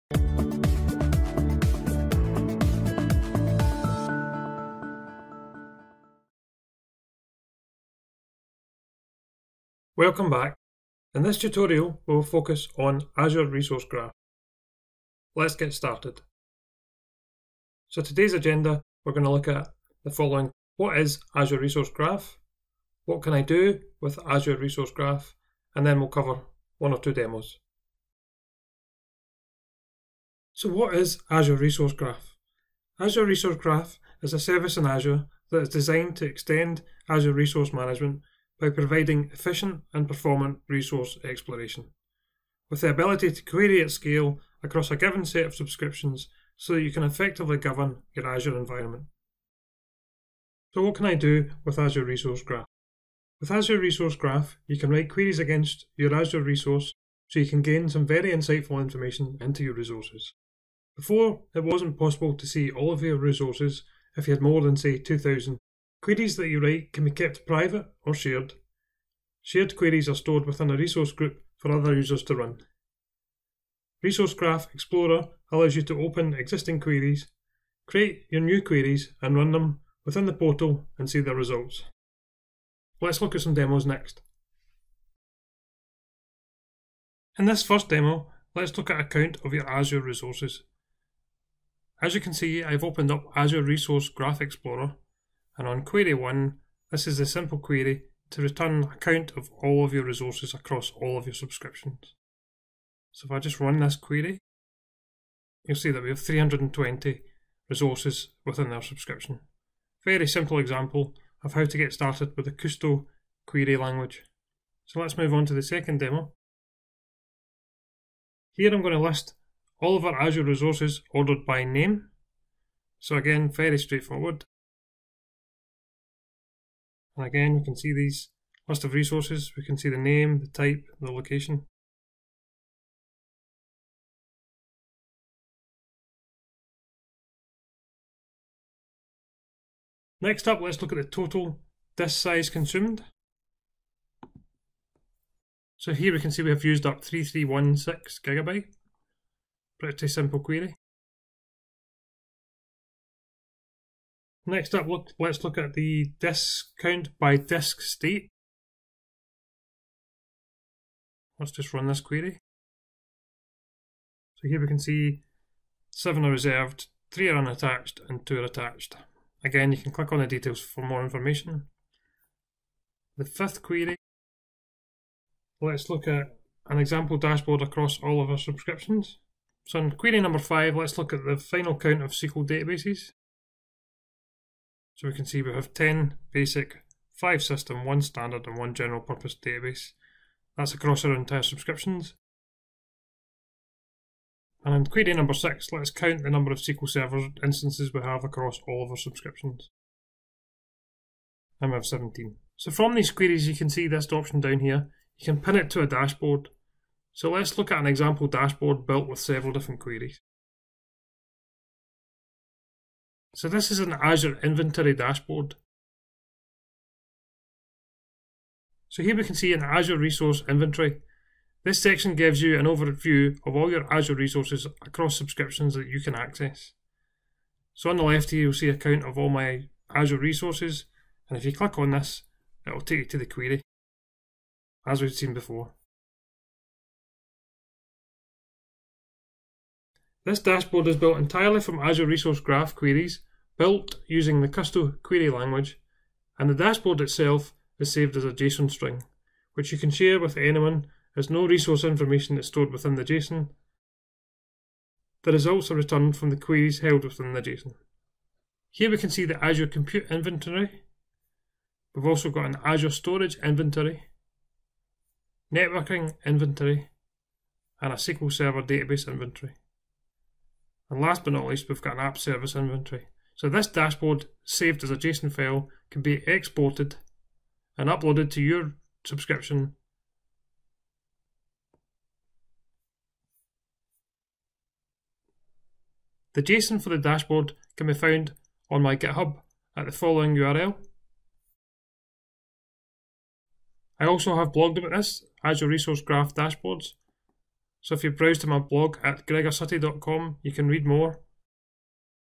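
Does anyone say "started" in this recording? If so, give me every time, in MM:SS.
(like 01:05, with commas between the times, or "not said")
00:15, 01:51.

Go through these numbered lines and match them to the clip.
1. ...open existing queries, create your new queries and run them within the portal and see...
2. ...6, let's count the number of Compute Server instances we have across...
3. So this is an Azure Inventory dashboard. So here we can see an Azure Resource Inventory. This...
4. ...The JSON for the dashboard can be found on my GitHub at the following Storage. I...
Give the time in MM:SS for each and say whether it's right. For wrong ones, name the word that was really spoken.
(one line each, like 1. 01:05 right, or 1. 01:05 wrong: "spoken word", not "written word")
1. 01:16 right
2. 03:15 wrong: "SQL", not "Compute"
3. 03:33 right
4. 04:46 wrong: "URL", not "Storage".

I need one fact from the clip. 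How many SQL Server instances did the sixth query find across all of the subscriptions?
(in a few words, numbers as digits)
17.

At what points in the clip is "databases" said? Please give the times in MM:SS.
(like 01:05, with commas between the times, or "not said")
03:02, 03:09, 04:28.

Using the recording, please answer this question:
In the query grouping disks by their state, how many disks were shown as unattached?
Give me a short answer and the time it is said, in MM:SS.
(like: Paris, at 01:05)
3, at 02:47.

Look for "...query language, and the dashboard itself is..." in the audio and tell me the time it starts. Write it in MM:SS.
04:05.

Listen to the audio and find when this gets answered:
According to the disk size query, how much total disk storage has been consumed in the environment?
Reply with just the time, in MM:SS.
02:27.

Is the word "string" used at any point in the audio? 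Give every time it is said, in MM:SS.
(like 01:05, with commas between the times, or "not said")
04:08.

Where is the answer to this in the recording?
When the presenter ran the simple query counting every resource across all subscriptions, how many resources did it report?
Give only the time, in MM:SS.
01:46.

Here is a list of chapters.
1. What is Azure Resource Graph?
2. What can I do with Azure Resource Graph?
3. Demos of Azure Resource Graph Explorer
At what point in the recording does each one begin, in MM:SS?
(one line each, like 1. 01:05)
1. 00:31
2. 00:54
3. 01:24.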